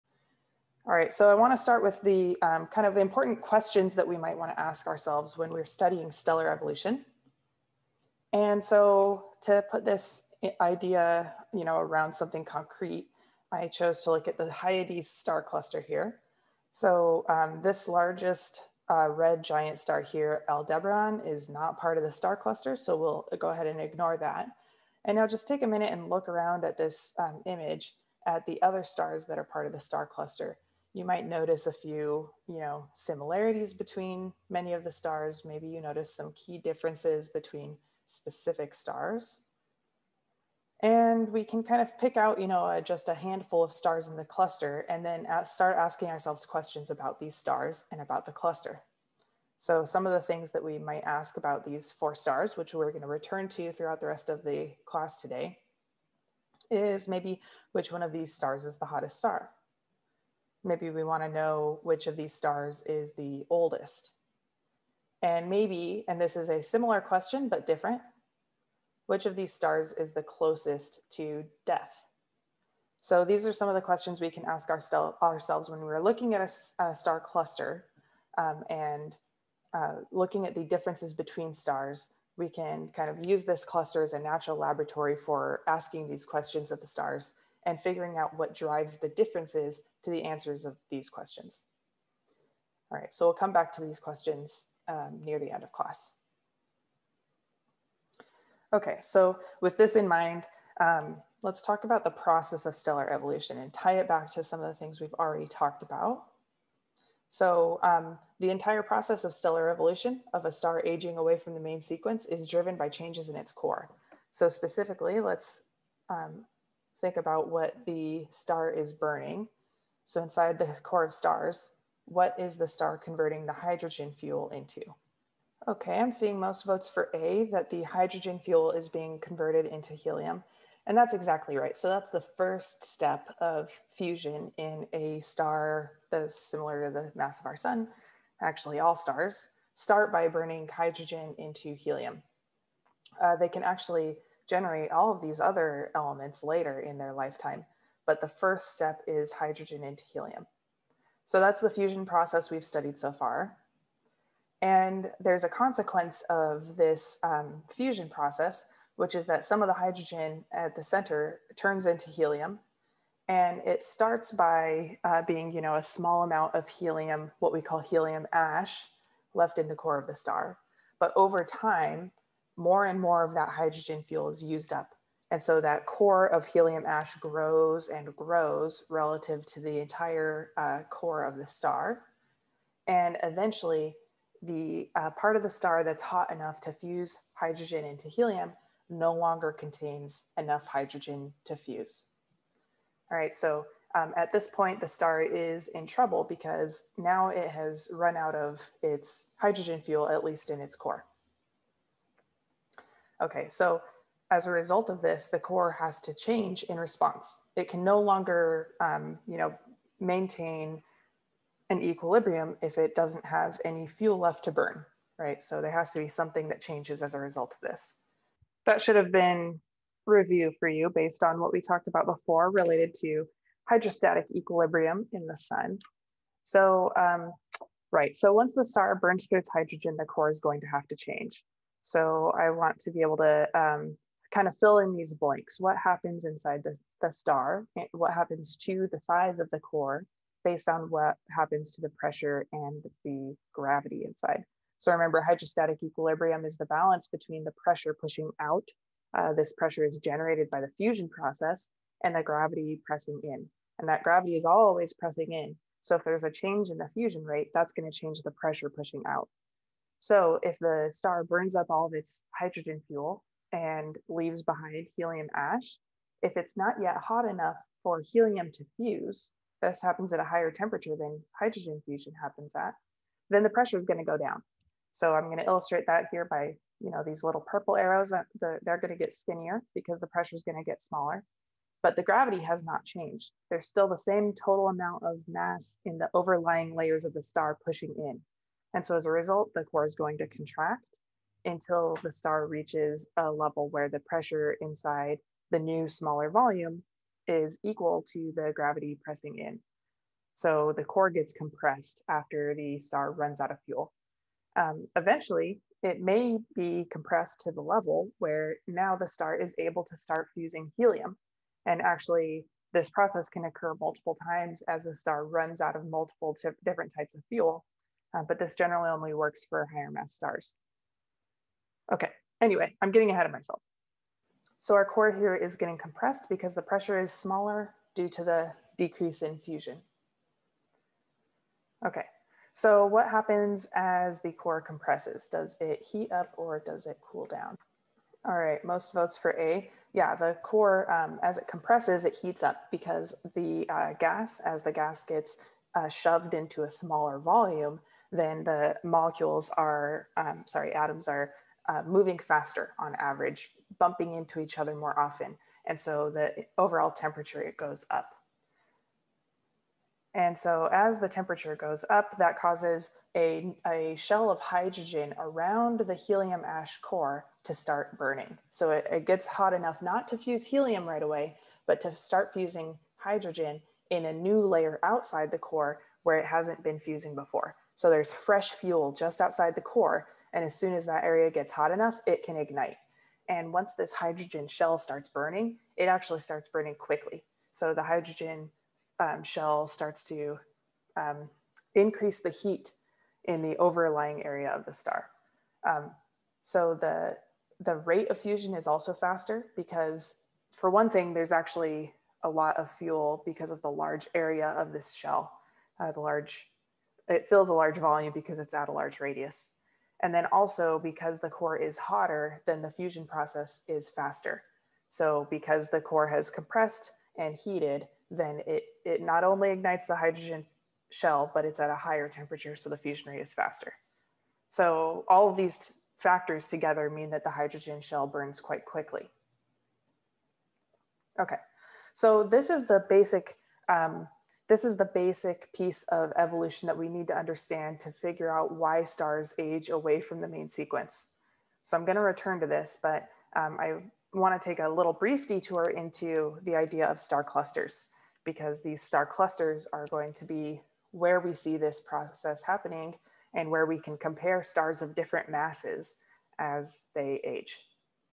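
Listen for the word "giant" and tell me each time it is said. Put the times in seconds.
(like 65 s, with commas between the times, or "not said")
19 s.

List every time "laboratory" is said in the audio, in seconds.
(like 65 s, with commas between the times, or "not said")
84 s.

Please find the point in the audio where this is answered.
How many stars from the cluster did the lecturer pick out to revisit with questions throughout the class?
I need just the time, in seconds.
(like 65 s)
51 s.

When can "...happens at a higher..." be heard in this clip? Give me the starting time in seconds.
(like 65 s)
269 s.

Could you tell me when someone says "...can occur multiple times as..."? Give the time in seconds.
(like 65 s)
313 s.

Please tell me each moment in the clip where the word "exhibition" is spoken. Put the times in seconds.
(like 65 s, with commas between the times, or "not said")
not said.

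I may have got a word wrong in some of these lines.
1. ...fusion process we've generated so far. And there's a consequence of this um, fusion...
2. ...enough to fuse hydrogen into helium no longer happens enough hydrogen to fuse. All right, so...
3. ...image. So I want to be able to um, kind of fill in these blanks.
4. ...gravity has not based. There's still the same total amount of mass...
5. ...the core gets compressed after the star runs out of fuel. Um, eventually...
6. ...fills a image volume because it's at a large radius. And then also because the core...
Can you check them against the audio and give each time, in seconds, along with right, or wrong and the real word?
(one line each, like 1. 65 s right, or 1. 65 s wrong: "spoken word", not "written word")
1. 151 s wrong: "studied", not "generated"
2. 186 s wrong: "contains", not "happens"
3. 230 s wrong: "change", not "image"
4. 282 s wrong: "changed", not "based"
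5. 300 s right
6. 407 s wrong: "large", not "image".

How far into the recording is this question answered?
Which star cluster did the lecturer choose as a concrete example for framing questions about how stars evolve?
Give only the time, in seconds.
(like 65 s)
14 s.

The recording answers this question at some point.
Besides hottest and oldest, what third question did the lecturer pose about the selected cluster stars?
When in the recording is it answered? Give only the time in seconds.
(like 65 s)
70 s.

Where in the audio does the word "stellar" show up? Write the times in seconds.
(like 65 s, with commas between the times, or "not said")
6 s, 102 s, 109 s.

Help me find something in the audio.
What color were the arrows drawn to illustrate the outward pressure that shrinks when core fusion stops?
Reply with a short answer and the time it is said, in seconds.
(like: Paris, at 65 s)
purple, at 277 s.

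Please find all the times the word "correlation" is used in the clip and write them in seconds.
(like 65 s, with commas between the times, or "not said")
not said.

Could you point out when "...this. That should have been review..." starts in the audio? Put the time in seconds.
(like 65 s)
217 s.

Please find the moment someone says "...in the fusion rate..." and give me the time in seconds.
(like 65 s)
256 s.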